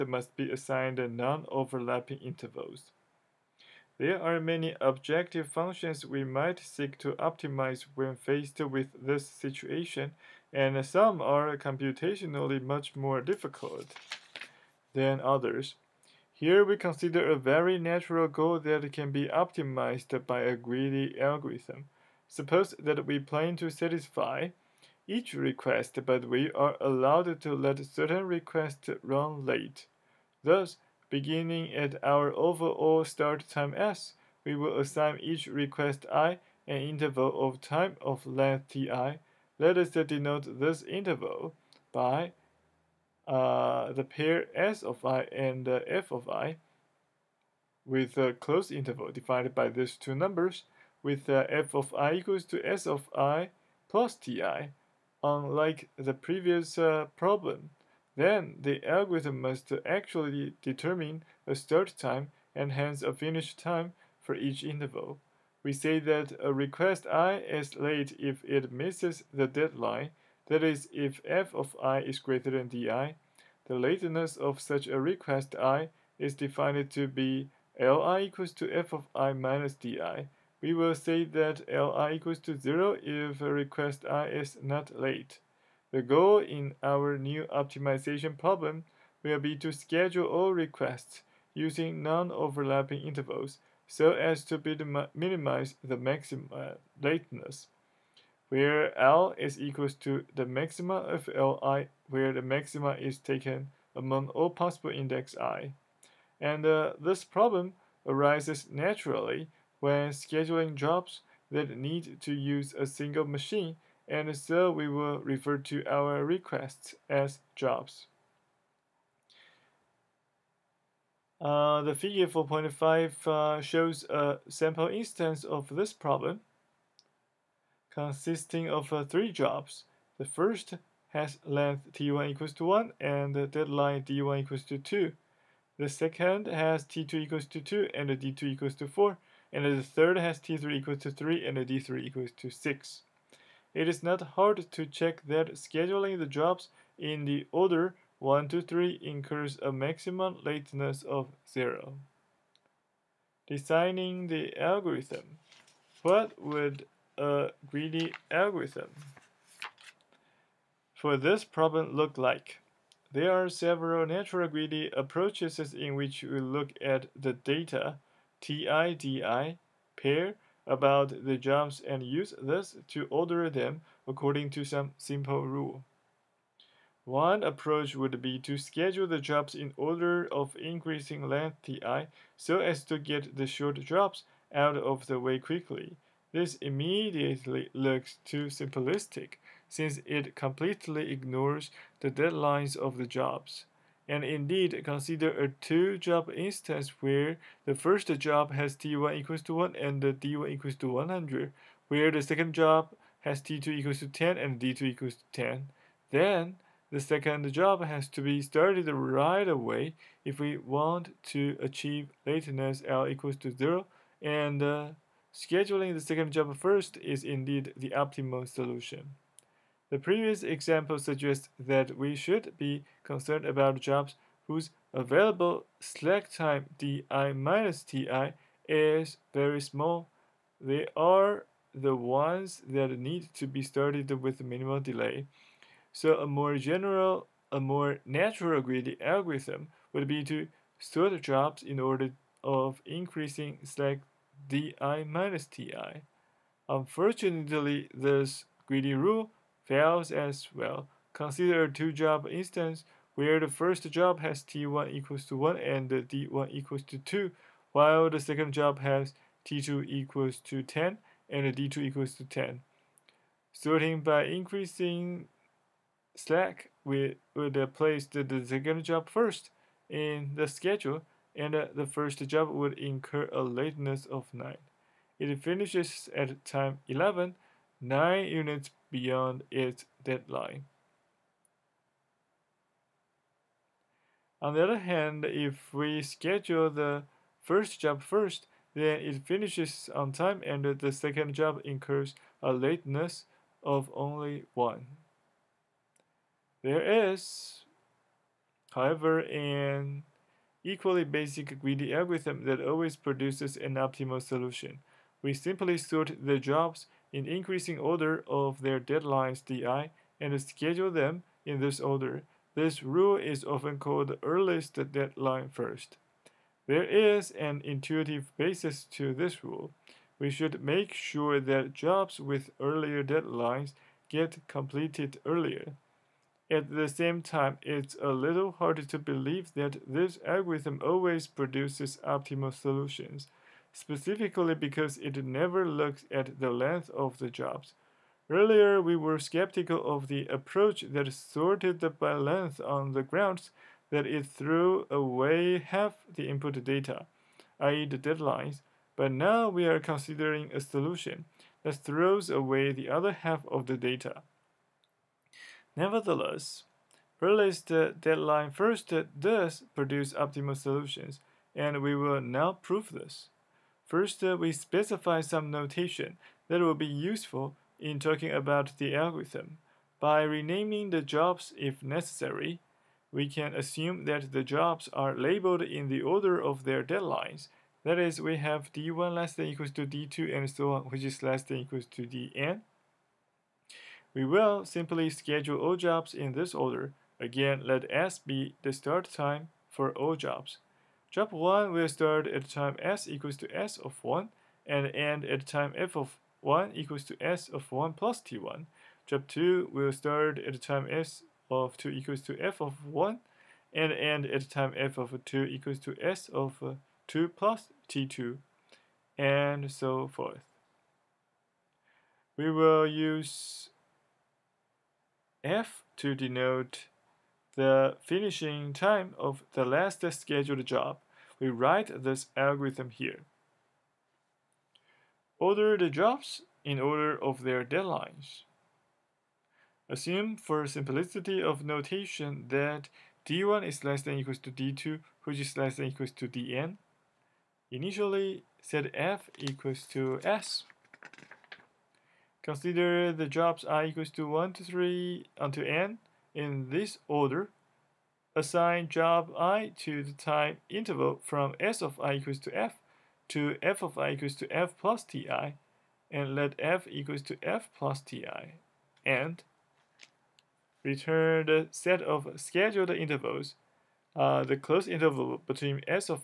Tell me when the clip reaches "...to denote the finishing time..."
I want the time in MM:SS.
06:55.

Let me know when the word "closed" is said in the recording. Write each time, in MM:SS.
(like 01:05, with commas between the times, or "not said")
00:48, 07:44.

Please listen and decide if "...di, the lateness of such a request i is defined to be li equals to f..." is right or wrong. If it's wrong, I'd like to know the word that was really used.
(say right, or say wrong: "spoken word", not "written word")
right.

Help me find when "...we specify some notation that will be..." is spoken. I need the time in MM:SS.
06:04.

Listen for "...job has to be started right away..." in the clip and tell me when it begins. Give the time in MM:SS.
03:27.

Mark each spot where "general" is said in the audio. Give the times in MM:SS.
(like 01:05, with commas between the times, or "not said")
03:56.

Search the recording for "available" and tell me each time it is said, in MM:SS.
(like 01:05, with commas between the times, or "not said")
03:44.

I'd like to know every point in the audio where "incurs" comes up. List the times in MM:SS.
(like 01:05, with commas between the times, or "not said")
02:29, 04:32, 04:51.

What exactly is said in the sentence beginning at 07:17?
Initially, set f equals to s.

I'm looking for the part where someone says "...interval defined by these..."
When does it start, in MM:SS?
00:48.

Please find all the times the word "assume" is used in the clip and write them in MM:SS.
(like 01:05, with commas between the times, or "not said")
06:13, 07:09.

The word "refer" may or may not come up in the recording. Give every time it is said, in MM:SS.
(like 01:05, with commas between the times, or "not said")
01:55.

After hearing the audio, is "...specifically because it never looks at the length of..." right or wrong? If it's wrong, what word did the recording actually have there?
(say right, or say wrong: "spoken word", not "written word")
right.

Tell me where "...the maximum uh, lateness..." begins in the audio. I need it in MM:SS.
01:35.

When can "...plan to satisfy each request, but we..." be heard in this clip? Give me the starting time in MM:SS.
00:23.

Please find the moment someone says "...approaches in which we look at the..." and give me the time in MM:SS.
02:44.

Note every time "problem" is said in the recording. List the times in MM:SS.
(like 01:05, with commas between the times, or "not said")
00:57, 01:28, 01:47, 02:05, 02:41.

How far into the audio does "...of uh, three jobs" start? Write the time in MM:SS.
02:08.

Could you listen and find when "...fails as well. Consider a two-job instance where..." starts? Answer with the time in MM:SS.
04:09.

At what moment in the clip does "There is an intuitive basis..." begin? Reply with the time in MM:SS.
05:16.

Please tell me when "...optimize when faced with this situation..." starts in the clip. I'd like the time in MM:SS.
00:07.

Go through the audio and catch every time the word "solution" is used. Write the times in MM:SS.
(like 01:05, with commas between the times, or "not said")
03:38, 05:04, 05:32, 05:50, 06:00.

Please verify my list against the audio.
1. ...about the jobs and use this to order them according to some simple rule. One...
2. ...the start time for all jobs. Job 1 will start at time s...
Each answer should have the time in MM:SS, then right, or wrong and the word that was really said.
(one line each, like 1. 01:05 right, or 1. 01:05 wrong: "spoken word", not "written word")
1. 02:50 right
2. 06:28 right.